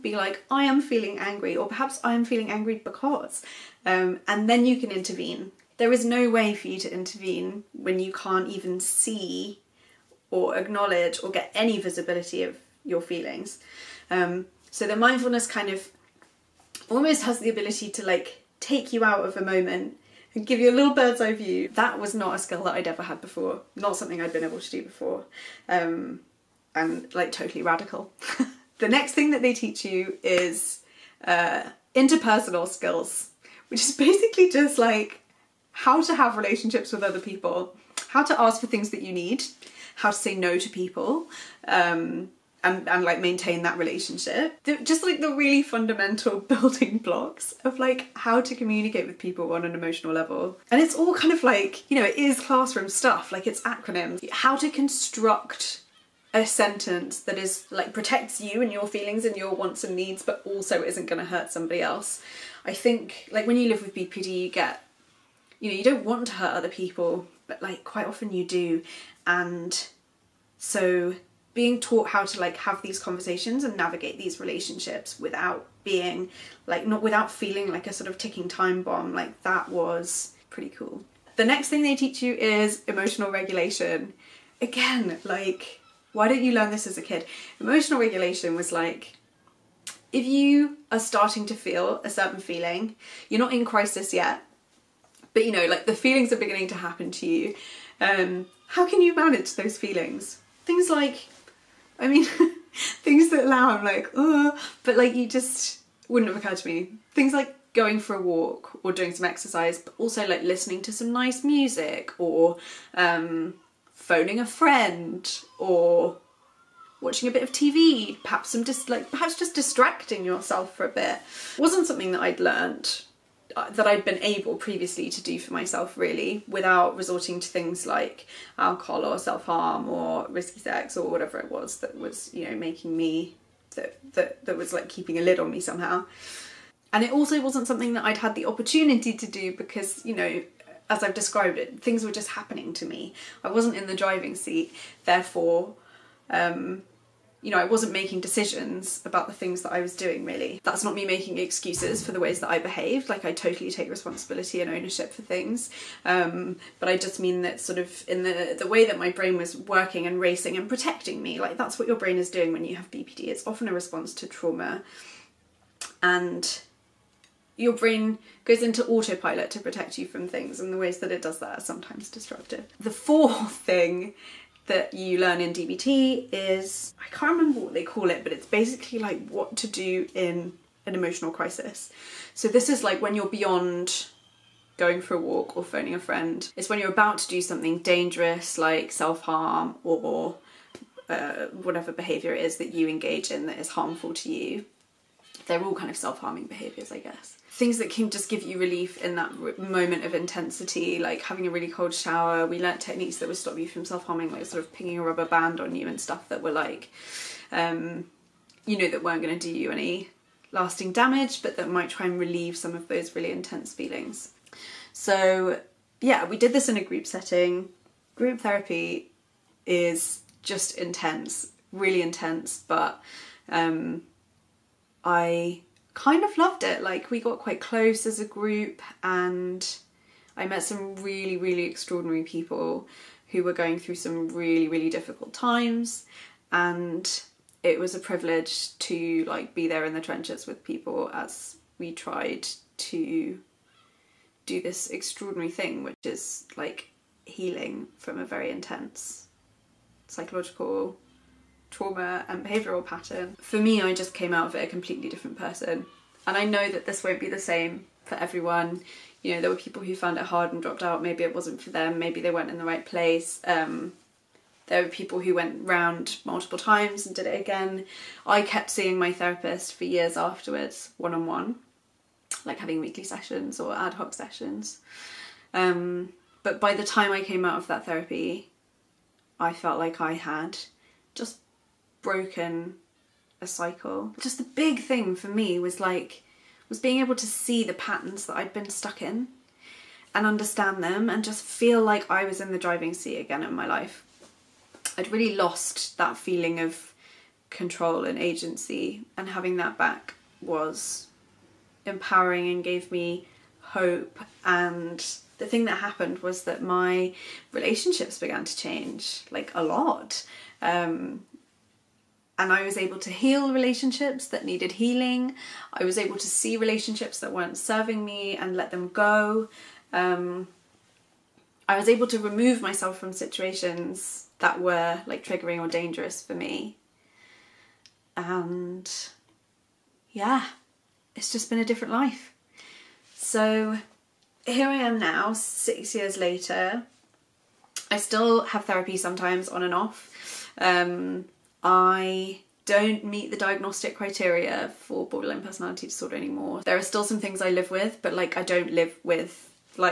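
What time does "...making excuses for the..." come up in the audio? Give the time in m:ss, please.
2:31.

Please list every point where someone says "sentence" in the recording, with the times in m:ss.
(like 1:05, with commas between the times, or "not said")
0:56.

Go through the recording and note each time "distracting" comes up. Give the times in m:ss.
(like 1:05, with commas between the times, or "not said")
1:59.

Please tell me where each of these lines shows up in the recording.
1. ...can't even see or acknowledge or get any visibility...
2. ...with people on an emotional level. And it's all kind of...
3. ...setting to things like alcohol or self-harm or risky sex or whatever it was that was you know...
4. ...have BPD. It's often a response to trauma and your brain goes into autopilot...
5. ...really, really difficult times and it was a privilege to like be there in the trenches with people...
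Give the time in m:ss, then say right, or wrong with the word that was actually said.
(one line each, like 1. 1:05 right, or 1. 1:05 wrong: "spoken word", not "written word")
1. 0:08 right
2. 0:49 right
3. 2:06 wrong: "resorting", not "setting"
4. 2:42 right
5. 3:54 right.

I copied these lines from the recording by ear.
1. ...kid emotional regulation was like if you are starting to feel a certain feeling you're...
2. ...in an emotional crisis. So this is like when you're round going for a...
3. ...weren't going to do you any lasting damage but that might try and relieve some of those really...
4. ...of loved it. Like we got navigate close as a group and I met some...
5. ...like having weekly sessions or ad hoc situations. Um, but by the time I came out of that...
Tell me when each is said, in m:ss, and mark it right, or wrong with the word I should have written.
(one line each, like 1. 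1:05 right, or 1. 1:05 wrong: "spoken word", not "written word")
1. 1:27 right
2. 3:00 wrong: "beyond", not "round"
3. 3:29 right
4. 3:46 wrong: "quite", not "navigate"
5. 4:32 wrong: "sessions", not "situations".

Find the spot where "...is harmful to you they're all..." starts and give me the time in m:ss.
3:13.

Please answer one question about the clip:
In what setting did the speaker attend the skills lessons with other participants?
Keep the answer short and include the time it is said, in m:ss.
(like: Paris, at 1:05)
a group setting, at 3:36.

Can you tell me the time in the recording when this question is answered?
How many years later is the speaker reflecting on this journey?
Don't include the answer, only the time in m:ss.
5:35.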